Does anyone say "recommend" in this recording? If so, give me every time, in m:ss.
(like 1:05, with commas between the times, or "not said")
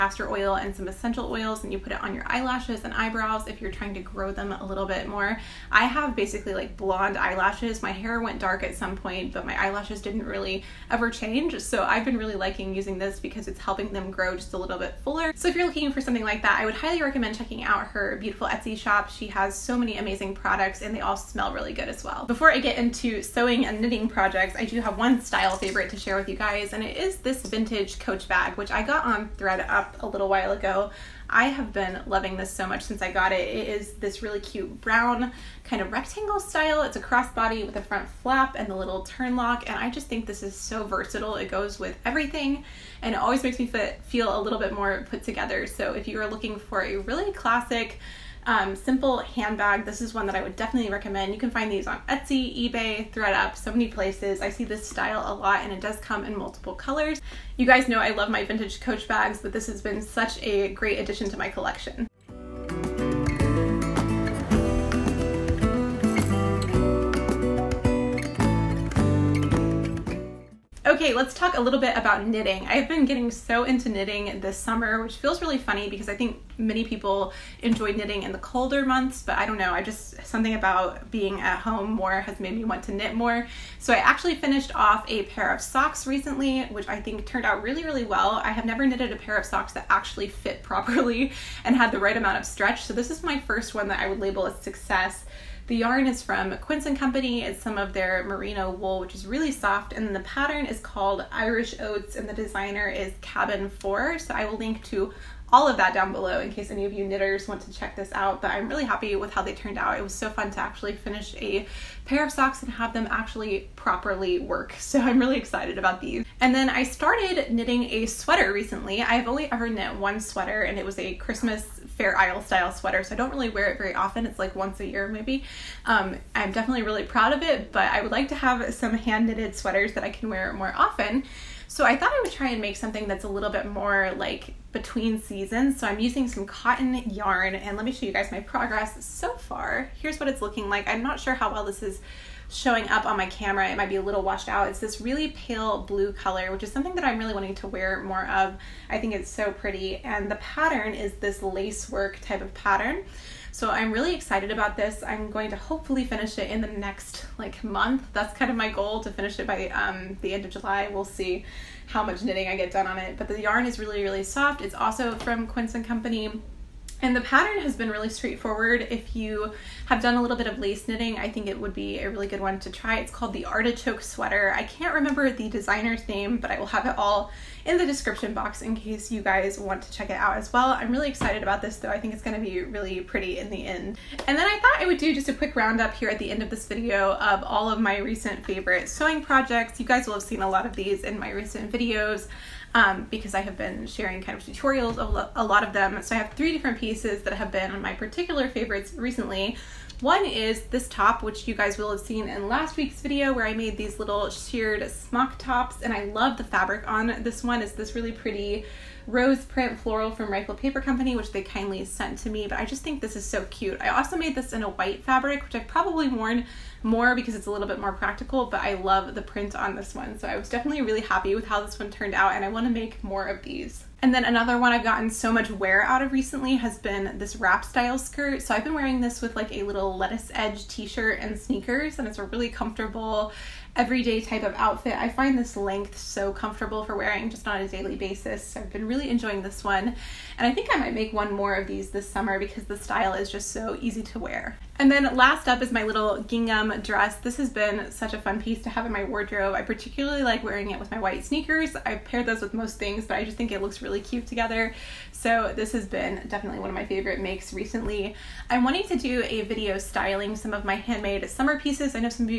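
0:17, 0:50.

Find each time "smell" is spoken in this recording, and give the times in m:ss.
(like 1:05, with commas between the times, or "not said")
0:21.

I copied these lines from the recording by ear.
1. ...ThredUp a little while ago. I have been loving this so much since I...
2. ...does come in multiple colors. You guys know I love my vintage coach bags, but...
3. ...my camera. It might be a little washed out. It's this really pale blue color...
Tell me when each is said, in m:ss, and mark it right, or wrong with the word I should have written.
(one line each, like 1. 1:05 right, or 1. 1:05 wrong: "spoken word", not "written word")
1. 0:29 right
2. 0:55 right
3. 2:23 right.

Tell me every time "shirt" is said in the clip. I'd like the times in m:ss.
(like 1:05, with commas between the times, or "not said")
3:50.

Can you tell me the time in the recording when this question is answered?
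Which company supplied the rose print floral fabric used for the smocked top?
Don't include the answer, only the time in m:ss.
3:30.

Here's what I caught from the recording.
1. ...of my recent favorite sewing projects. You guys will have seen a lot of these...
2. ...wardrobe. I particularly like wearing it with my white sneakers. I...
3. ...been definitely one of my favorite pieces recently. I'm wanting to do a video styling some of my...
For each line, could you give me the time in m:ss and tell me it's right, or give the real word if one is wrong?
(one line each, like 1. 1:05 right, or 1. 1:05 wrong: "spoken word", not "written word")
1. 3:07 right
2. 4:09 right
3. 4:15 wrong: "makes", not "pieces".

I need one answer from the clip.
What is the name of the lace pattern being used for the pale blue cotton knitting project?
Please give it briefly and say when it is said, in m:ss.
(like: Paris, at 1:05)
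Artichoke Sweater, at 2:53.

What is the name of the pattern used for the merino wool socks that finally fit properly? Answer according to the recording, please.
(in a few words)
Irish Oats.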